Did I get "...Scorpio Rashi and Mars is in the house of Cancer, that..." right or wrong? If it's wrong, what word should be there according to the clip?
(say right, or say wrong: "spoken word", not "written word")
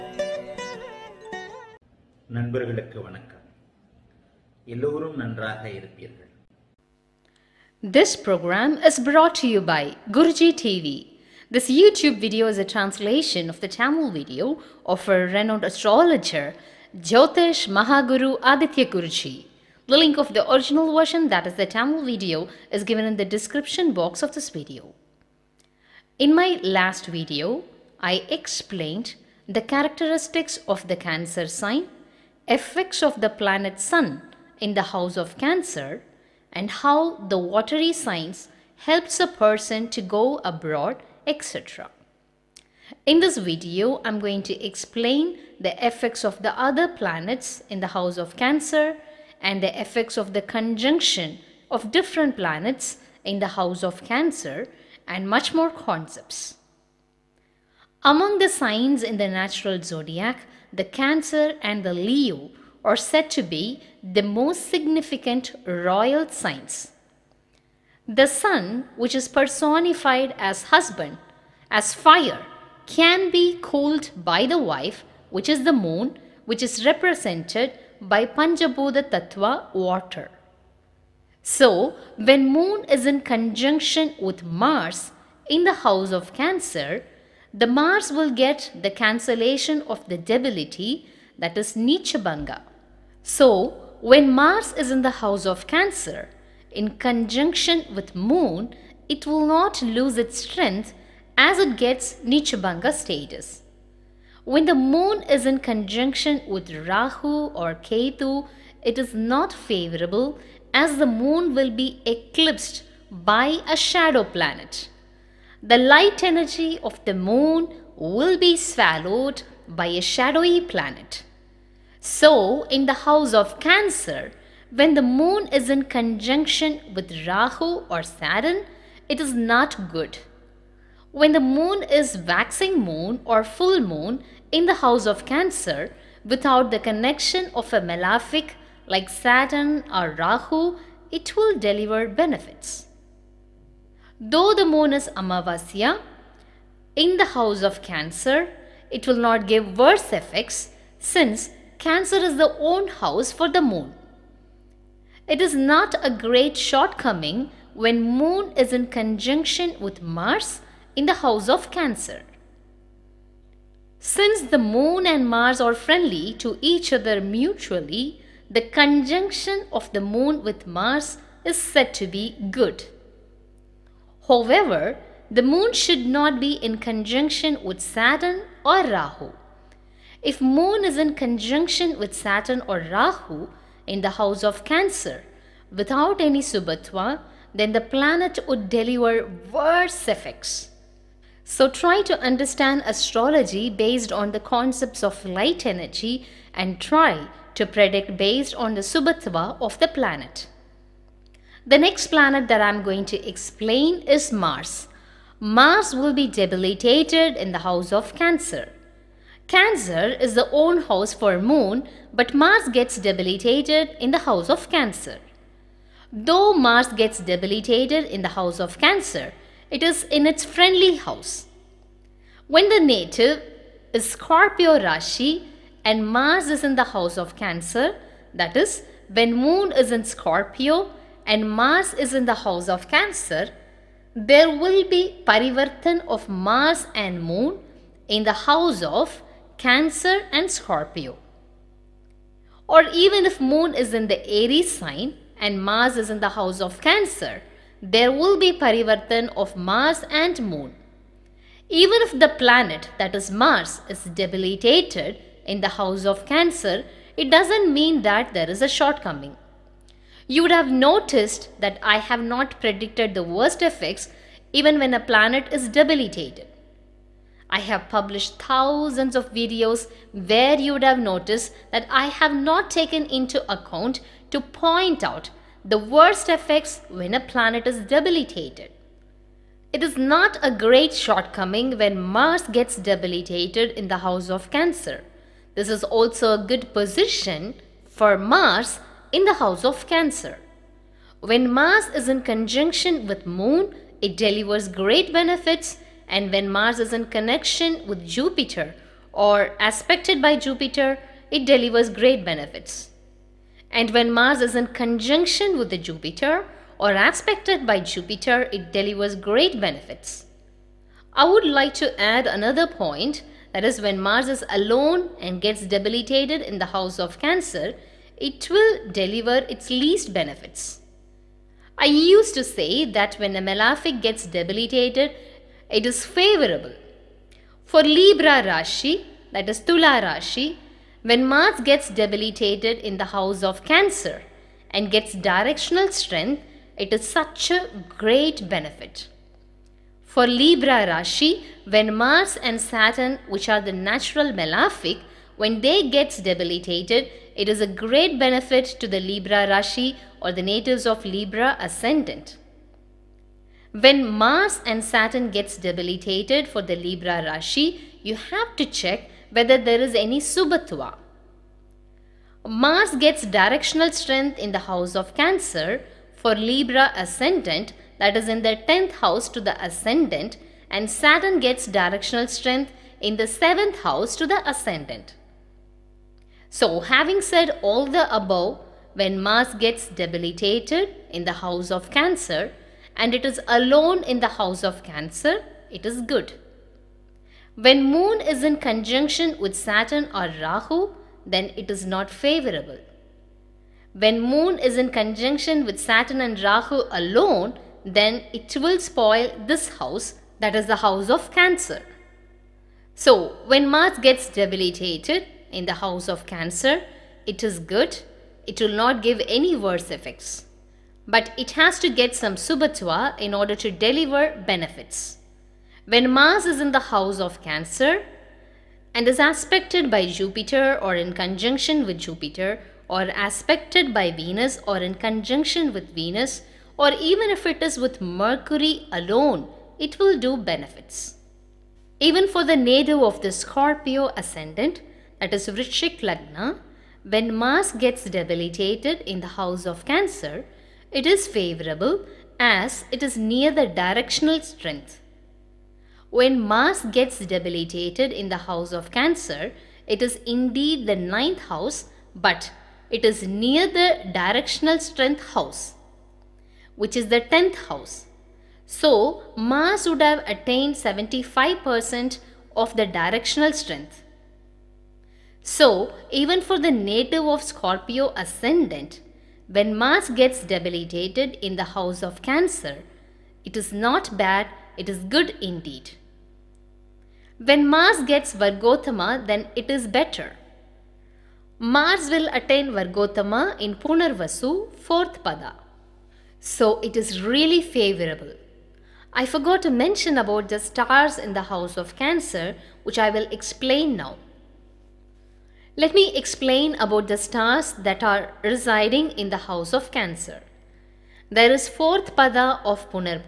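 right.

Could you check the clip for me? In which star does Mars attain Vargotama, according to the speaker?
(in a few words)
Punarvasu.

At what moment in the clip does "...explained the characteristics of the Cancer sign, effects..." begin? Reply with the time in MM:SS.
00:28.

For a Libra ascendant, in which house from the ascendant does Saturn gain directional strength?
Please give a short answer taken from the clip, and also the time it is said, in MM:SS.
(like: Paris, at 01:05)
7th house, at 06:13.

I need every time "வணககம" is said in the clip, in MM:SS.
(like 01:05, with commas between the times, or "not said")
00:03.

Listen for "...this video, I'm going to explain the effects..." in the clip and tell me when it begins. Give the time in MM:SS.
00:43.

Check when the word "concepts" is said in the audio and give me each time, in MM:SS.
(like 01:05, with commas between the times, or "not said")
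00:55, 03:14.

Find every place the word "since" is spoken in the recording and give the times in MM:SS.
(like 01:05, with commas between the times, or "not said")
02:30, 02:44.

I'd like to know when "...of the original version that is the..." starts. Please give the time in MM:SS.
00:20.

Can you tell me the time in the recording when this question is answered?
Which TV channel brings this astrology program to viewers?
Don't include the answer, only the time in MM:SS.
00:10.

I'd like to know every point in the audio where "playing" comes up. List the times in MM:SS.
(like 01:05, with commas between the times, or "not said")
not said.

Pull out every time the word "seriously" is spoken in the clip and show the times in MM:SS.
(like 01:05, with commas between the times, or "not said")
not said.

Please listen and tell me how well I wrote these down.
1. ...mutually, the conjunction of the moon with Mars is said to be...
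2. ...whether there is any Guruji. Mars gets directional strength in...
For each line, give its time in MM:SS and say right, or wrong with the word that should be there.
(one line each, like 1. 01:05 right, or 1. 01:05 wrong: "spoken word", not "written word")
1. 02:47 right
2. 05:59 wrong: "Subatva", not "Guruji".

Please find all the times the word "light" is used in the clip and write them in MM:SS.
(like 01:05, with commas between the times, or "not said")
01:55, 03:15.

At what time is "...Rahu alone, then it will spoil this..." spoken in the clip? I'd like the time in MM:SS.
06:36.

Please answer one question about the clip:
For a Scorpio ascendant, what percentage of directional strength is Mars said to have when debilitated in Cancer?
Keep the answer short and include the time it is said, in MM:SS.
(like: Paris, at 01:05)
75%, at 07:40.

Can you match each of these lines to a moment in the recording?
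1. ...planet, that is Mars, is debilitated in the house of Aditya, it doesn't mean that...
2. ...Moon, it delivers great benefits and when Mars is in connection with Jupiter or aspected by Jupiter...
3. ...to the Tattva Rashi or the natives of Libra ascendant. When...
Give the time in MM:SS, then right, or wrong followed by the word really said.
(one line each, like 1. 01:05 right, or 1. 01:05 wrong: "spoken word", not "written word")
1. 04:12 wrong: "Cancer", not "Aditya"
2. 04:53 right
3. 05:48 wrong: "Libra", not "Tattva".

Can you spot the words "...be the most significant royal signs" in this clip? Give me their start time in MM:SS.
01:03.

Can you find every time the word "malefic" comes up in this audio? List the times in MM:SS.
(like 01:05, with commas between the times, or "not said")
02:17, 05:23, 05:44.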